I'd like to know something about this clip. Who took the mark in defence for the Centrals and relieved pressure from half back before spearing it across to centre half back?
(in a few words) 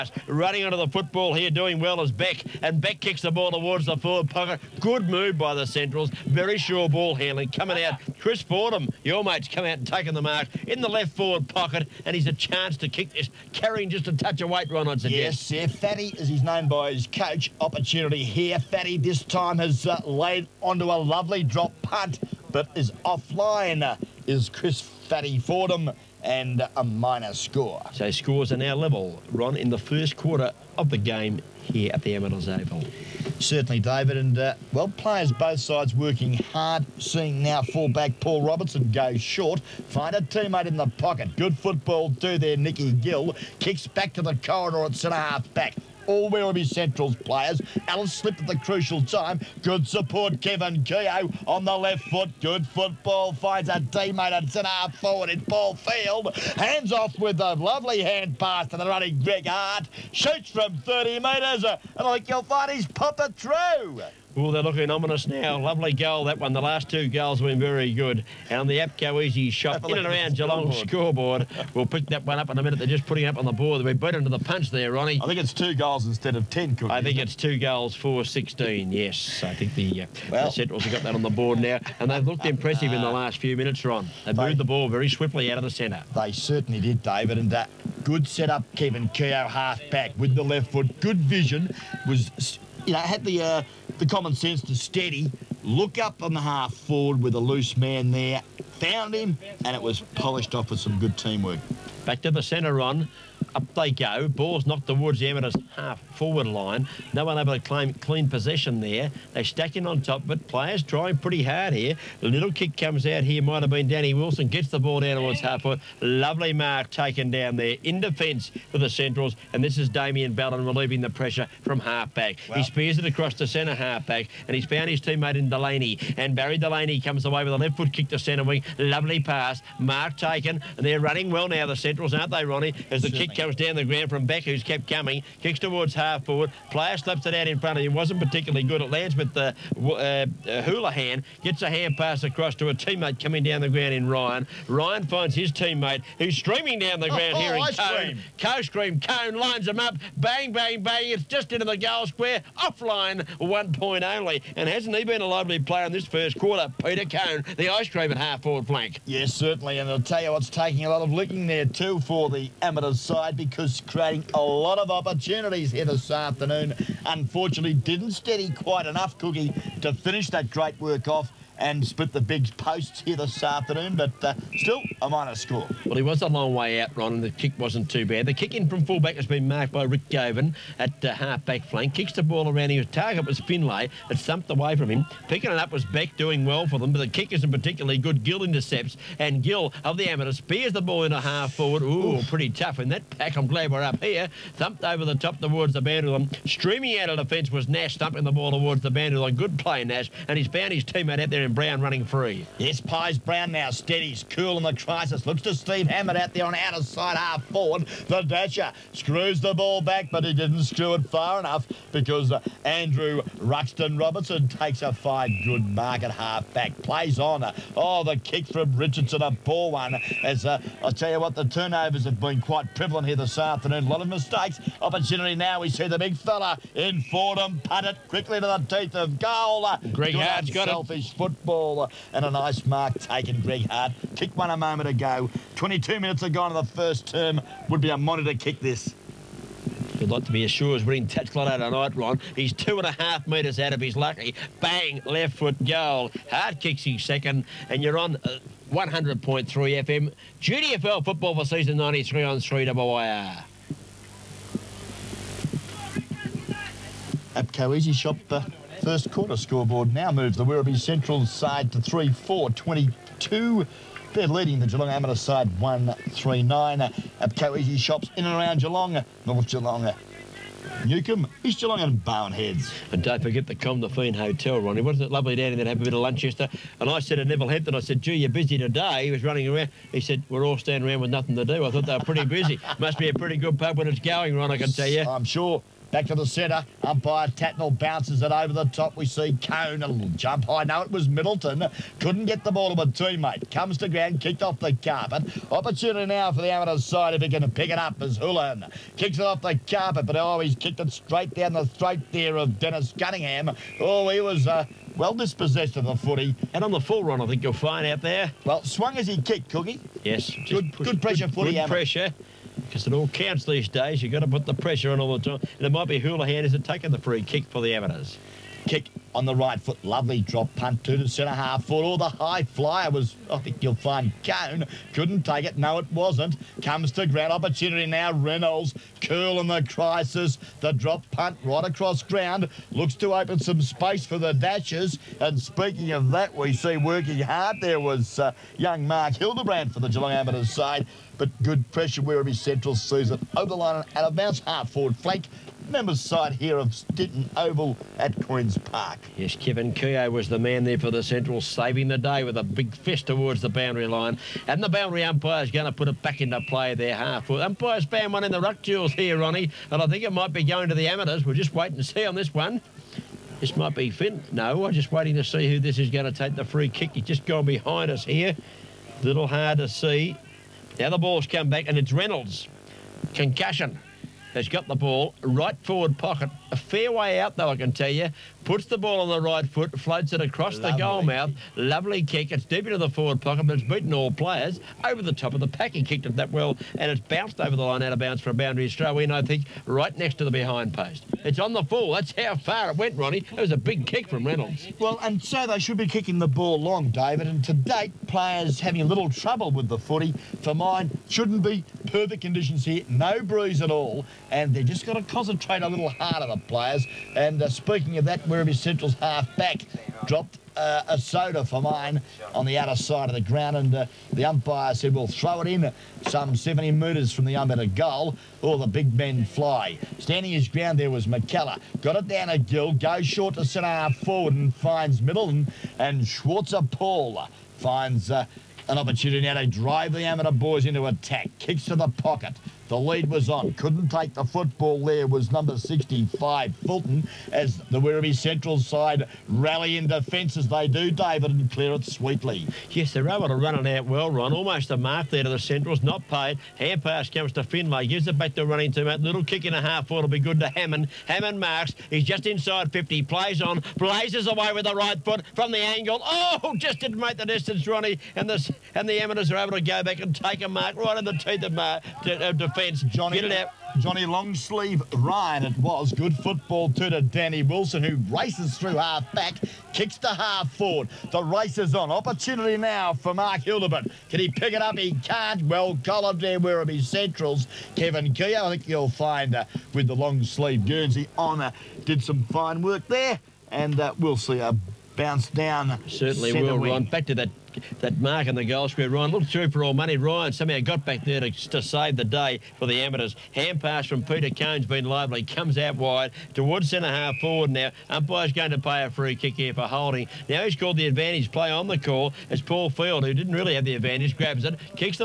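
Damien Ballon.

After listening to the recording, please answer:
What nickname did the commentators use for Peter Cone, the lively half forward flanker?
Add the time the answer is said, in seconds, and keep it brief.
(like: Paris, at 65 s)
the ice cream, at 157 s.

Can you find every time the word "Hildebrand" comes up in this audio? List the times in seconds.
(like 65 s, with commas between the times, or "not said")
339 s, 473 s.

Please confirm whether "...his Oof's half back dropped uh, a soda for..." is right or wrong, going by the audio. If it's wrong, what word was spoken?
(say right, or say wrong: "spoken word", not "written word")
wrong: "Central", not "Oof".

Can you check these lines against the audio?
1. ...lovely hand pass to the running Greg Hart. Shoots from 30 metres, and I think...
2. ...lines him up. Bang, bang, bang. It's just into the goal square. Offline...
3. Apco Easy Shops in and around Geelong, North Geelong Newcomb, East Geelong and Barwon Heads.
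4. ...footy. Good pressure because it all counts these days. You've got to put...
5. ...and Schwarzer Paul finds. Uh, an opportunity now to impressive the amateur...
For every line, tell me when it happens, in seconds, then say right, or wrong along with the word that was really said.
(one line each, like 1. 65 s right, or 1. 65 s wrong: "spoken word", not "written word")
1. 57 s right
2. 149 s right
3. 267 s right
4. 311 s right
5. 425 s wrong: "drive", not "impressive".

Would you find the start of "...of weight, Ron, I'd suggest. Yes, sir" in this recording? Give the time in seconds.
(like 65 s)
14 s.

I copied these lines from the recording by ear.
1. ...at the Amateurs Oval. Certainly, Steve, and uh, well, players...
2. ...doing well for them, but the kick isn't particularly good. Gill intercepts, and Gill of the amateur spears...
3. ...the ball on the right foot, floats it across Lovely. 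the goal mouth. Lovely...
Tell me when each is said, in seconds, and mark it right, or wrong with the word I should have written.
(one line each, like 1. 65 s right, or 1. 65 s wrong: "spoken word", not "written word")
1. 31 s wrong: "David", not "Steve"
2. 186 s right
3. 378 s right.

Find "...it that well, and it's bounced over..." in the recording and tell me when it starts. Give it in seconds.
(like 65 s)
386 s.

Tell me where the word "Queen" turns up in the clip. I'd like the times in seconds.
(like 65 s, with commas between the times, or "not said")
348 s.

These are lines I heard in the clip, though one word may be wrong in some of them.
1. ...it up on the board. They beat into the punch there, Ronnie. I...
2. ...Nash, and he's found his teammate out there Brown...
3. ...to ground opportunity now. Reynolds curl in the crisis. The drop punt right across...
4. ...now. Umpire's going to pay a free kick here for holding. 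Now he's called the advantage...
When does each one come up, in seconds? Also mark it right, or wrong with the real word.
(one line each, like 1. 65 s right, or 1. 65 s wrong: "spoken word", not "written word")
1. 73 s right
2. 199 s right
3. 326 s right
4. 497 s right.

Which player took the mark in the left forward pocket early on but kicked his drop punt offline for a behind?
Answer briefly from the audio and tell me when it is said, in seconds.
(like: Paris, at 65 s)
Chris Fordham, at 8 s.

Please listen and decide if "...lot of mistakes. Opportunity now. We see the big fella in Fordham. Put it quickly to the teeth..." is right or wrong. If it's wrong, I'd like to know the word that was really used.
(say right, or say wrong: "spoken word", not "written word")
right.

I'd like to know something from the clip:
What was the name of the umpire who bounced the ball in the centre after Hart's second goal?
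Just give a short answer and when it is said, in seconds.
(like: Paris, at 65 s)
Tatnell, at 287 s.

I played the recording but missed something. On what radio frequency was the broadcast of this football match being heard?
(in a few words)
100.3 FM.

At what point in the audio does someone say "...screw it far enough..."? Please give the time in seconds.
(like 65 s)
210 s.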